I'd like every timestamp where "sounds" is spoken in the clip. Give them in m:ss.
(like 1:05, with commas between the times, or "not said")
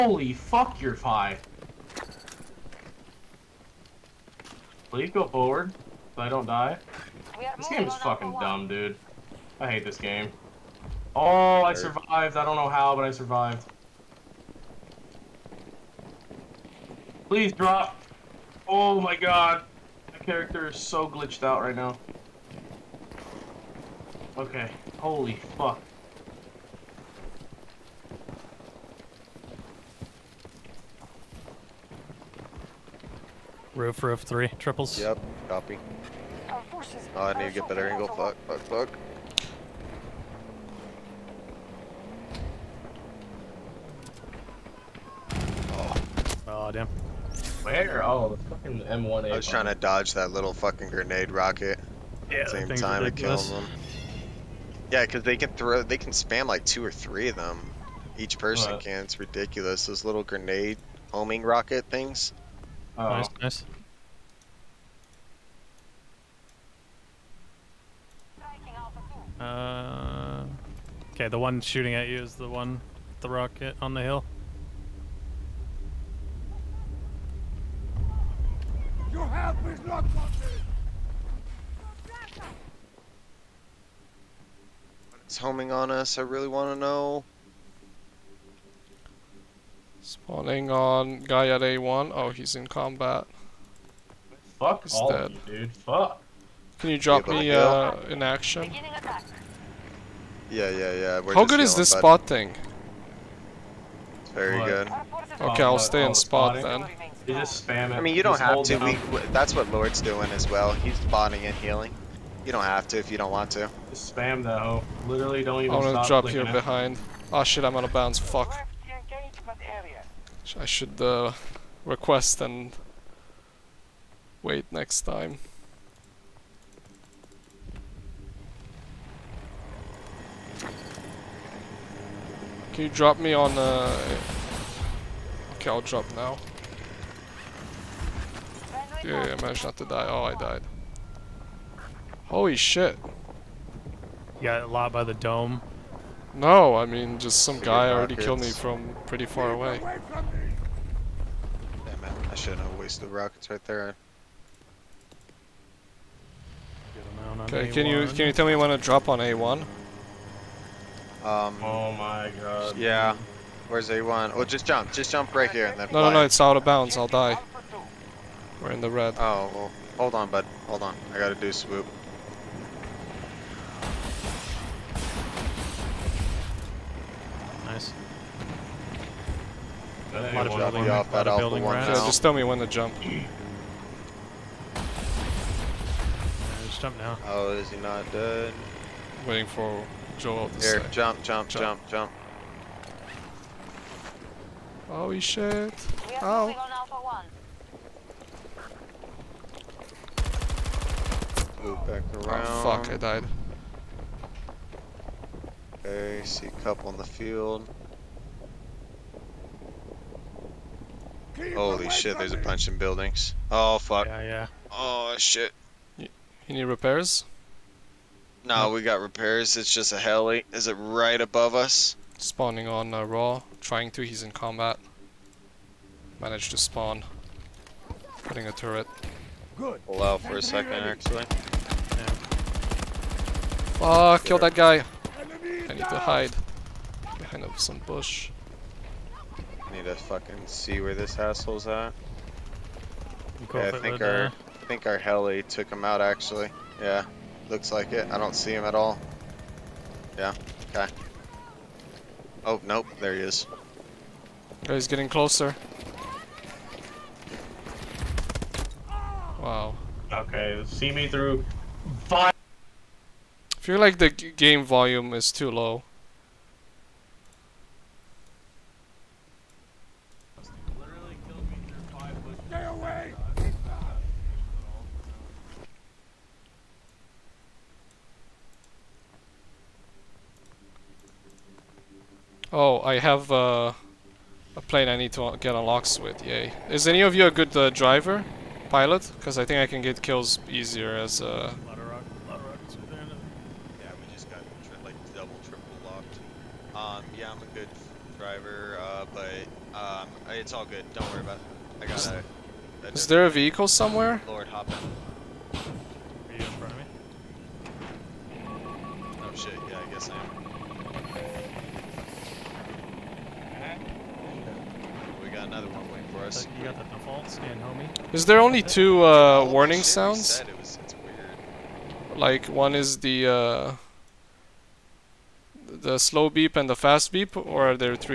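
5:19.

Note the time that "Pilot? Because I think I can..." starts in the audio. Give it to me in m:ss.
4:48.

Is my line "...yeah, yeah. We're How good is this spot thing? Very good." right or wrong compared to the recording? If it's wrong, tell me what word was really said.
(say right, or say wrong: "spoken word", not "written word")
right.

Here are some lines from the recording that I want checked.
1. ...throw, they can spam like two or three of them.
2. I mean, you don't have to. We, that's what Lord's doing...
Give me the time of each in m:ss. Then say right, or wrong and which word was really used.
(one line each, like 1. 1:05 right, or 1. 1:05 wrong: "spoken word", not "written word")
1. 0:55 right
2. 1:47 right.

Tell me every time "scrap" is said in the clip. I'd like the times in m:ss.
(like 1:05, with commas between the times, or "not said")
not said.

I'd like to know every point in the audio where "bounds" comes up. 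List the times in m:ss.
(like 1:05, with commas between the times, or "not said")
1:57, 2:46.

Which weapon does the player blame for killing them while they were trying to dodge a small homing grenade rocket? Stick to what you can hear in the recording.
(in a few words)
M1A.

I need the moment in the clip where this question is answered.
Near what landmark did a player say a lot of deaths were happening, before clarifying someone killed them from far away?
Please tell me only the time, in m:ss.
2:25.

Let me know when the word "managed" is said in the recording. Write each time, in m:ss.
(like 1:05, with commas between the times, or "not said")
2:19, 3:46.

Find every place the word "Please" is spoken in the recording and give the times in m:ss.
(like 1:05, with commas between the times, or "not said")
0:04, 0:17.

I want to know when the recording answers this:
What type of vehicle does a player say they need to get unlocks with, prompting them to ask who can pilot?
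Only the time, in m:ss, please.
4:44.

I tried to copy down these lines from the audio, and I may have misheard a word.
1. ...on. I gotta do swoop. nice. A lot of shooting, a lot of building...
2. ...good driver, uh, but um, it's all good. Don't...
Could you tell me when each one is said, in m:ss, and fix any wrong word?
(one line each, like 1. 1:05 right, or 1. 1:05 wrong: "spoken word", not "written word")
1. 2:50 wrong: "building", not "shooting"
2. 4:57 right.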